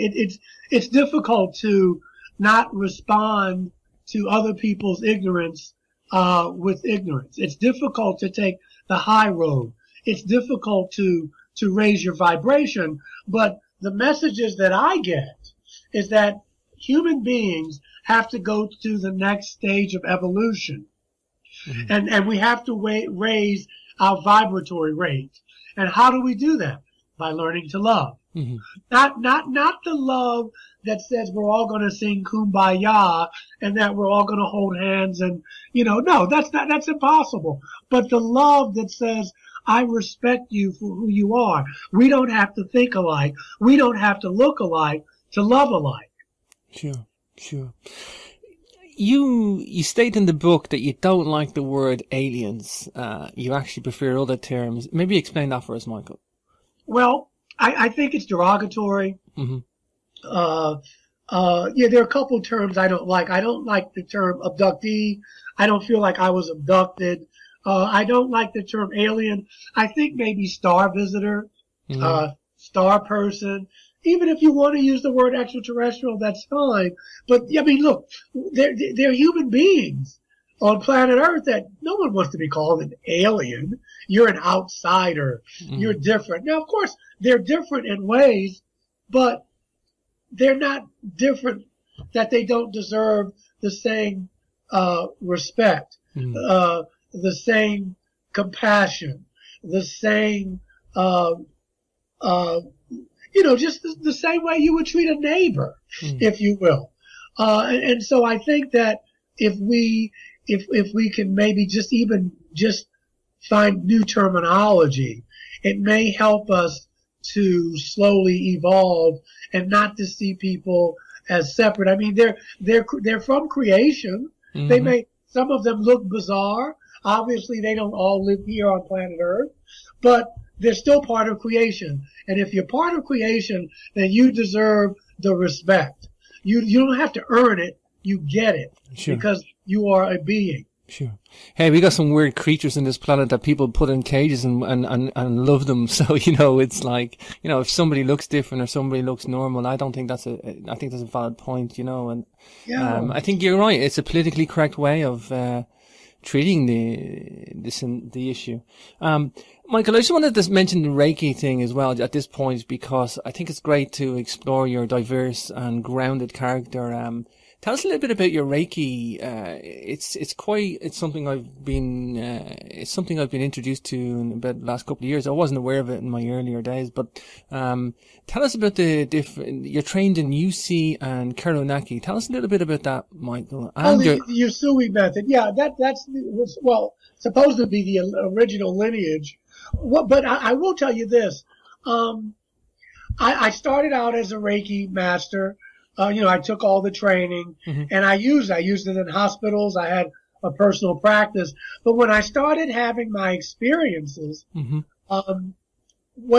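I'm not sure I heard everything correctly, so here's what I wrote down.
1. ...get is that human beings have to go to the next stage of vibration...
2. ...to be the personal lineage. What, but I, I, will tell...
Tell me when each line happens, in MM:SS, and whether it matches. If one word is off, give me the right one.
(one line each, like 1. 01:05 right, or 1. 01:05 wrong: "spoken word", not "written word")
1. 00:14 wrong: "evolution", not "vibration"
2. 03:07 wrong: "original", not "personal".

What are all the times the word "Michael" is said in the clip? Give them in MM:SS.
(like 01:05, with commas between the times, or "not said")
00:55, 02:39, 03:03.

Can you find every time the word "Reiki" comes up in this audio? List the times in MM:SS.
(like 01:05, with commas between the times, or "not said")
02:40, 02:48, 03:14.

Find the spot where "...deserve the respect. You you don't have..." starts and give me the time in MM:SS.
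02:14.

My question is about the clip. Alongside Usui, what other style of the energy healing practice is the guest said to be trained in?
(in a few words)
Karuna Ki.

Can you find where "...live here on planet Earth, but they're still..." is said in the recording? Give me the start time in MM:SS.
02:08.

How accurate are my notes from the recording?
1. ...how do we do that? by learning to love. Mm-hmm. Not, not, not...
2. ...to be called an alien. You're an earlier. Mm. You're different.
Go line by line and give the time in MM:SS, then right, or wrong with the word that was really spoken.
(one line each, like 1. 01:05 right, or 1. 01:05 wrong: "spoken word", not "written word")
1. 00:25 right
2. 01:22 wrong: "outsider", not "earlier".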